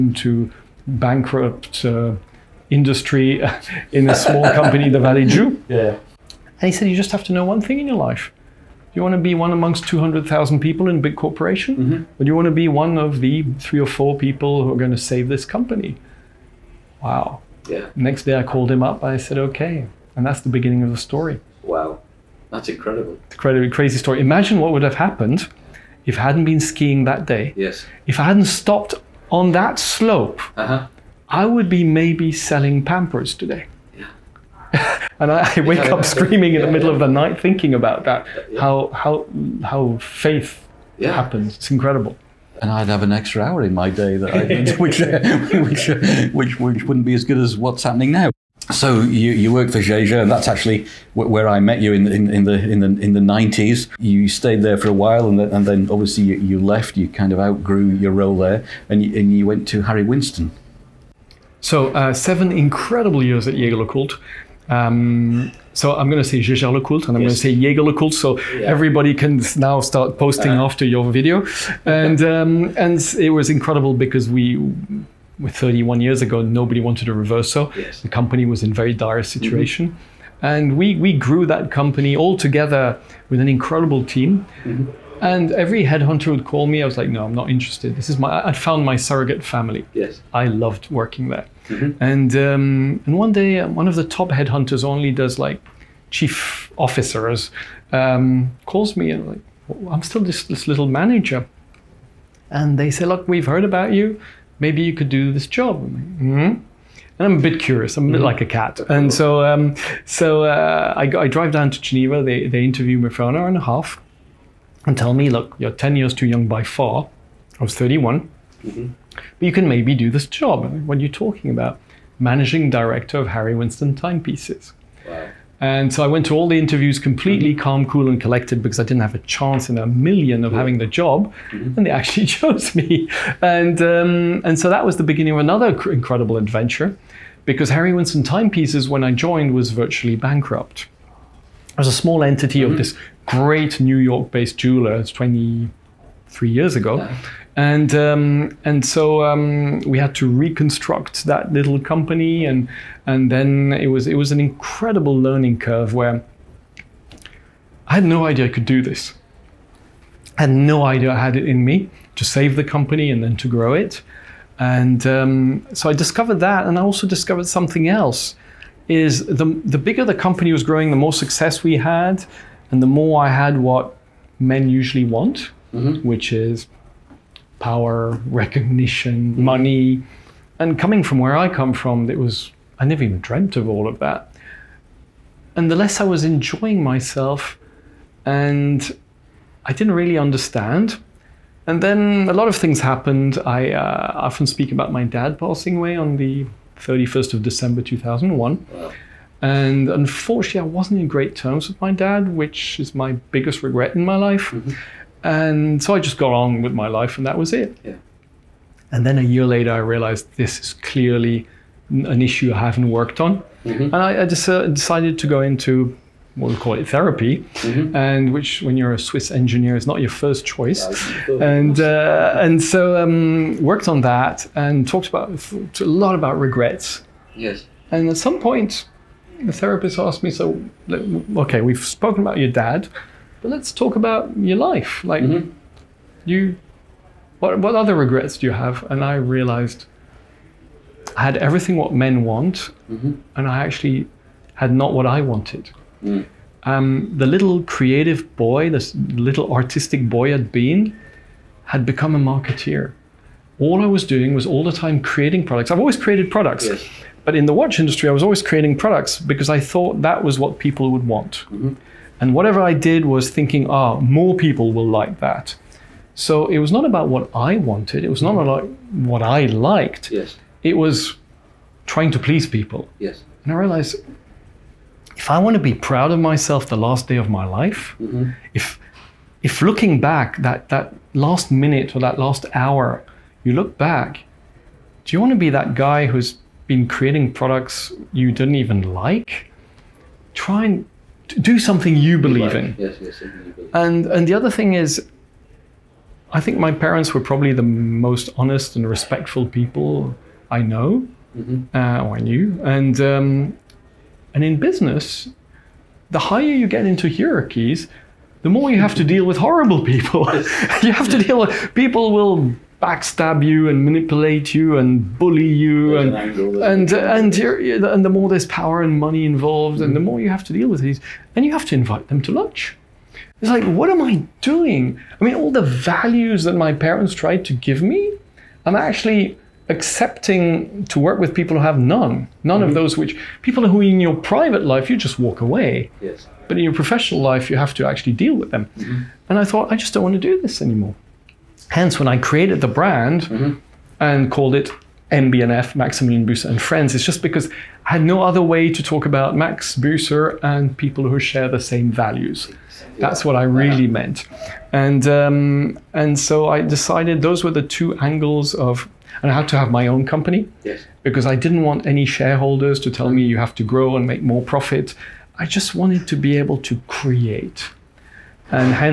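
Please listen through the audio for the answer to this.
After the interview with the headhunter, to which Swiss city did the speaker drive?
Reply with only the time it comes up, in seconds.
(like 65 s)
111 s.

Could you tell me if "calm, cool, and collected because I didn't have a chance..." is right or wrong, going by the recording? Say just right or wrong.
right.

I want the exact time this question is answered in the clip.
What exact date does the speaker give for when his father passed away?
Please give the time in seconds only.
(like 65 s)
196 s.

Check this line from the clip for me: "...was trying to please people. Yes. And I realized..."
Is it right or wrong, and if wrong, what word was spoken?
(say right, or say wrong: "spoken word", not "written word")
right.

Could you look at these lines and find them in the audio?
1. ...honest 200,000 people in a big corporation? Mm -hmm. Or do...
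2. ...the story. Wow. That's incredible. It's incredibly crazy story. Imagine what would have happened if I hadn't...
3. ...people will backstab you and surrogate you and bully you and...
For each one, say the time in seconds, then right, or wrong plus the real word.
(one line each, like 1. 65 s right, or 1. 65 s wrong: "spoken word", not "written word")
1. 9 s wrong: "amongst", not "honest"
2. 20 s right
3. 311 s wrong: "manipulate", not "surrogate".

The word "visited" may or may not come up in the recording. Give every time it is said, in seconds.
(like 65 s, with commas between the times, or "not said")
not said.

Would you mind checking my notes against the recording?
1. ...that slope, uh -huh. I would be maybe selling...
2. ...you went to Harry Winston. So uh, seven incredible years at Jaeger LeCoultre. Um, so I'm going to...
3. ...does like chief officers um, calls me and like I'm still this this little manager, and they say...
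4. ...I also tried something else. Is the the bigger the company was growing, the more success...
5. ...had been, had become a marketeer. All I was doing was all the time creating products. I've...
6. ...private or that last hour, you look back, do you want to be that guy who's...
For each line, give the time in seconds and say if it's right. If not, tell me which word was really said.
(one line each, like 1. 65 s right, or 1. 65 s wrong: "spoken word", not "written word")
1. 29 s right
2. 59 s right
3. 95 s right
4. 166 s wrong: "discovered", not "tried"
5. 250 s right
6. 281 s wrong: "minute", not "private".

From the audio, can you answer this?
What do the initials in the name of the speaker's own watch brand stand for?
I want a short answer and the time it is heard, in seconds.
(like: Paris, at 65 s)
Maximilian Büsser and Friends, at 345 s.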